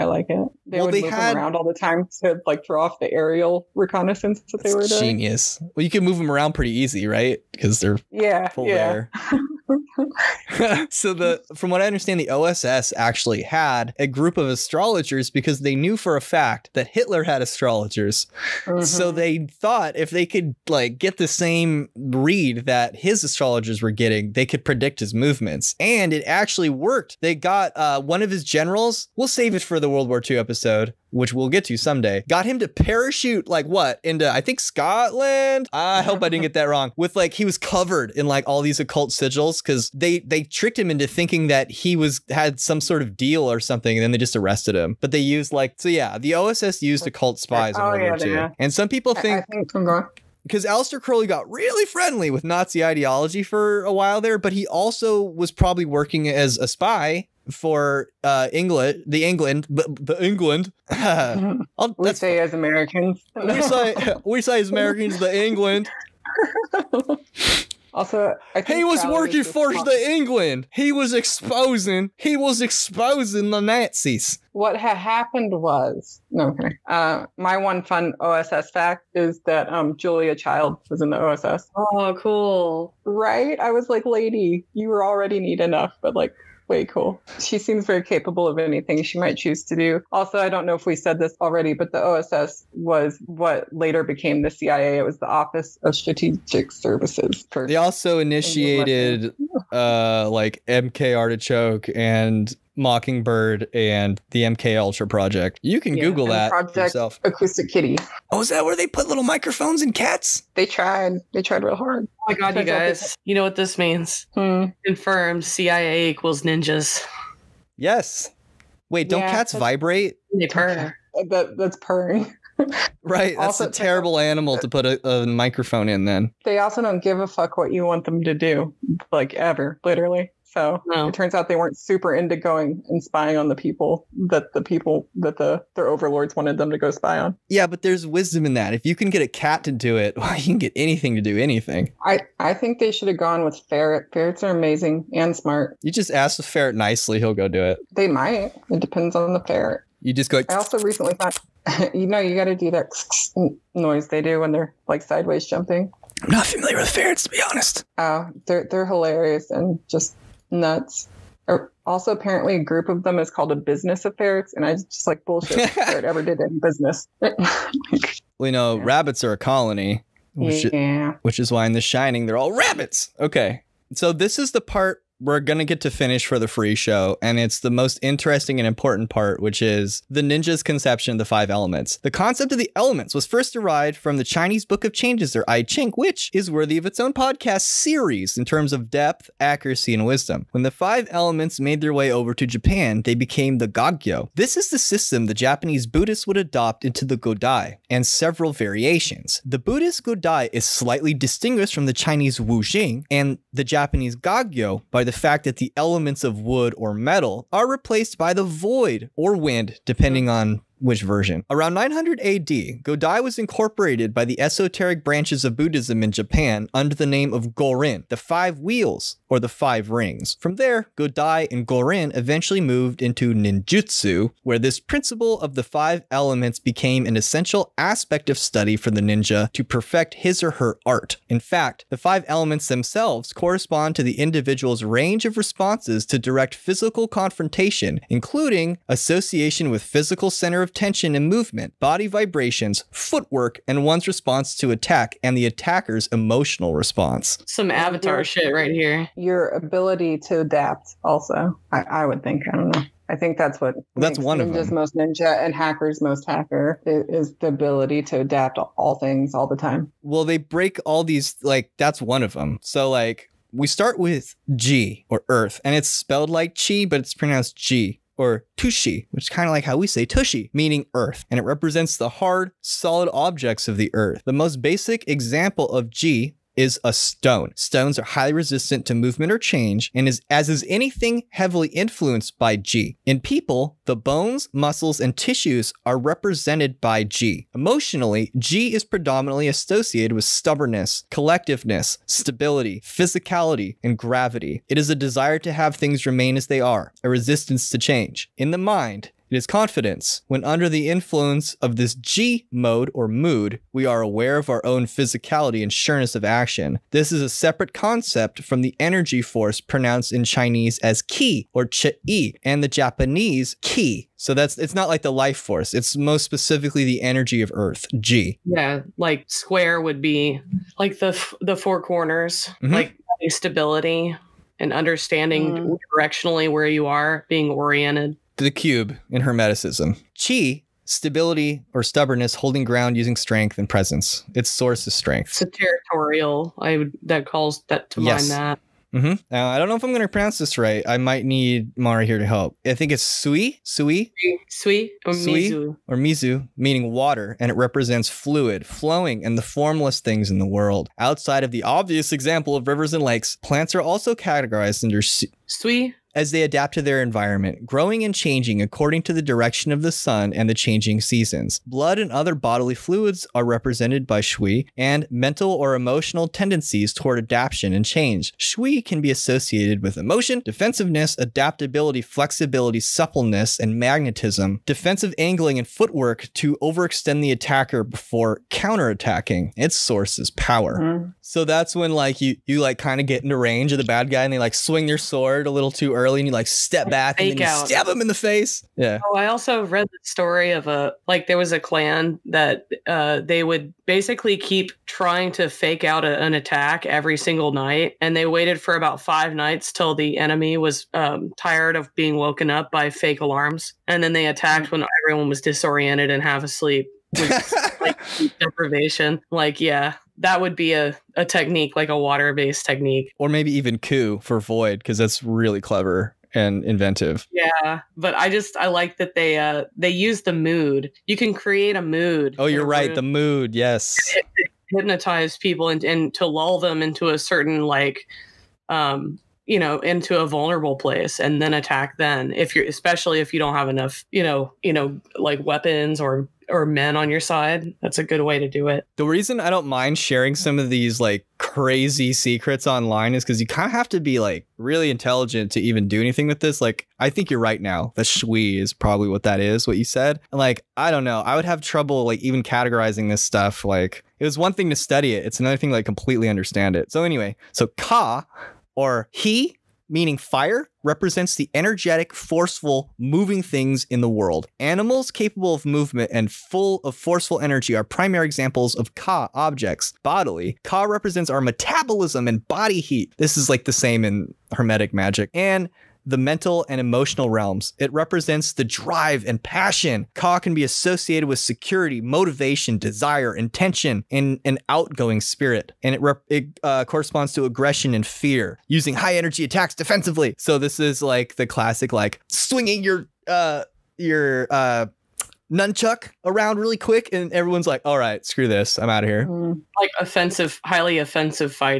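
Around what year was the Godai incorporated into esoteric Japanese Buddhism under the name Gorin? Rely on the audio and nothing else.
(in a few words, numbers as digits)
900 AD.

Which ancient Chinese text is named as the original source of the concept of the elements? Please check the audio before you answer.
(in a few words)
I Ching.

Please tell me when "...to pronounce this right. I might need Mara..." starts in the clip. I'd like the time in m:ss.
5:40.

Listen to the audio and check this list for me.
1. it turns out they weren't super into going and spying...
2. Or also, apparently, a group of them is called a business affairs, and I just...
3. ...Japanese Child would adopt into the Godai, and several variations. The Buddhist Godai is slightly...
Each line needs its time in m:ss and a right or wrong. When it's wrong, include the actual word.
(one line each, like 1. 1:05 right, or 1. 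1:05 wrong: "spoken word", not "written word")
1. 2:11 right
2. 2:41 right
3. 3:15 wrong: "Buddhists", not "Child".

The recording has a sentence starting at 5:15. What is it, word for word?
It's most specifically the energy of Earth, G.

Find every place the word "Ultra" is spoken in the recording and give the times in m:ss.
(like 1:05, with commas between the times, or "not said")
1:44.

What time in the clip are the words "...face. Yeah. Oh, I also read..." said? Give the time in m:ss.
6:28.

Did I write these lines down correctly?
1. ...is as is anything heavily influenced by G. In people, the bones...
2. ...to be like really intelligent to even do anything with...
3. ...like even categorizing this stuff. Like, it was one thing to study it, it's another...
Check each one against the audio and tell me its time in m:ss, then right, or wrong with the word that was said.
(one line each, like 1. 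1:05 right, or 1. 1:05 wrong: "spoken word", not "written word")
1. 4:40 right
2. 7:23 right
3. 7:32 right.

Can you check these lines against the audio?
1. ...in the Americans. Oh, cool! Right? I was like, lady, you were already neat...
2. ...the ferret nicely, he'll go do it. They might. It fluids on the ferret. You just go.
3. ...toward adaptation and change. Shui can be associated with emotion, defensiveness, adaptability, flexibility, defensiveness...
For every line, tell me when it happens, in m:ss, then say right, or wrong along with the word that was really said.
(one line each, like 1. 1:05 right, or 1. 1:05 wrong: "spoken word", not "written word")
1. 1:21 wrong: "OSS", not "Americans"
2. 2:26 wrong: "depends", not "fluids"
3. 6:06 wrong: "suppleness", not "defensiveness".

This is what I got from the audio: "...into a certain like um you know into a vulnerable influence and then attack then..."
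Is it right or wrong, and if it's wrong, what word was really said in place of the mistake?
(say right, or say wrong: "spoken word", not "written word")
wrong: "place", not "influence".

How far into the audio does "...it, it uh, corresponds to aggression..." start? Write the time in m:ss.
8:05.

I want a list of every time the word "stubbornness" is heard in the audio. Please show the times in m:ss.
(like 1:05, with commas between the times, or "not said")
4:50, 5:31.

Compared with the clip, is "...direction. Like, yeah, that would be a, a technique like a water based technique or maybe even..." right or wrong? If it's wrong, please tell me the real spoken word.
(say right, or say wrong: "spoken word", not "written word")
wrong: "deprivation", not "direction".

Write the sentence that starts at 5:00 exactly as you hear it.
When under the influence of this G mode or mood, we are aware of our own physicality and sureness of action.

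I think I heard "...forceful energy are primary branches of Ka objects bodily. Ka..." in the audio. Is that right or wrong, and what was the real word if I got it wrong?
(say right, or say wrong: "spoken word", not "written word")
wrong: "examples", not "branches".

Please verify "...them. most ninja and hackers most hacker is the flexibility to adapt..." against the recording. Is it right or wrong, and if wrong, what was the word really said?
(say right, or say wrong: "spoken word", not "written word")
wrong: "ability", not "flexibility".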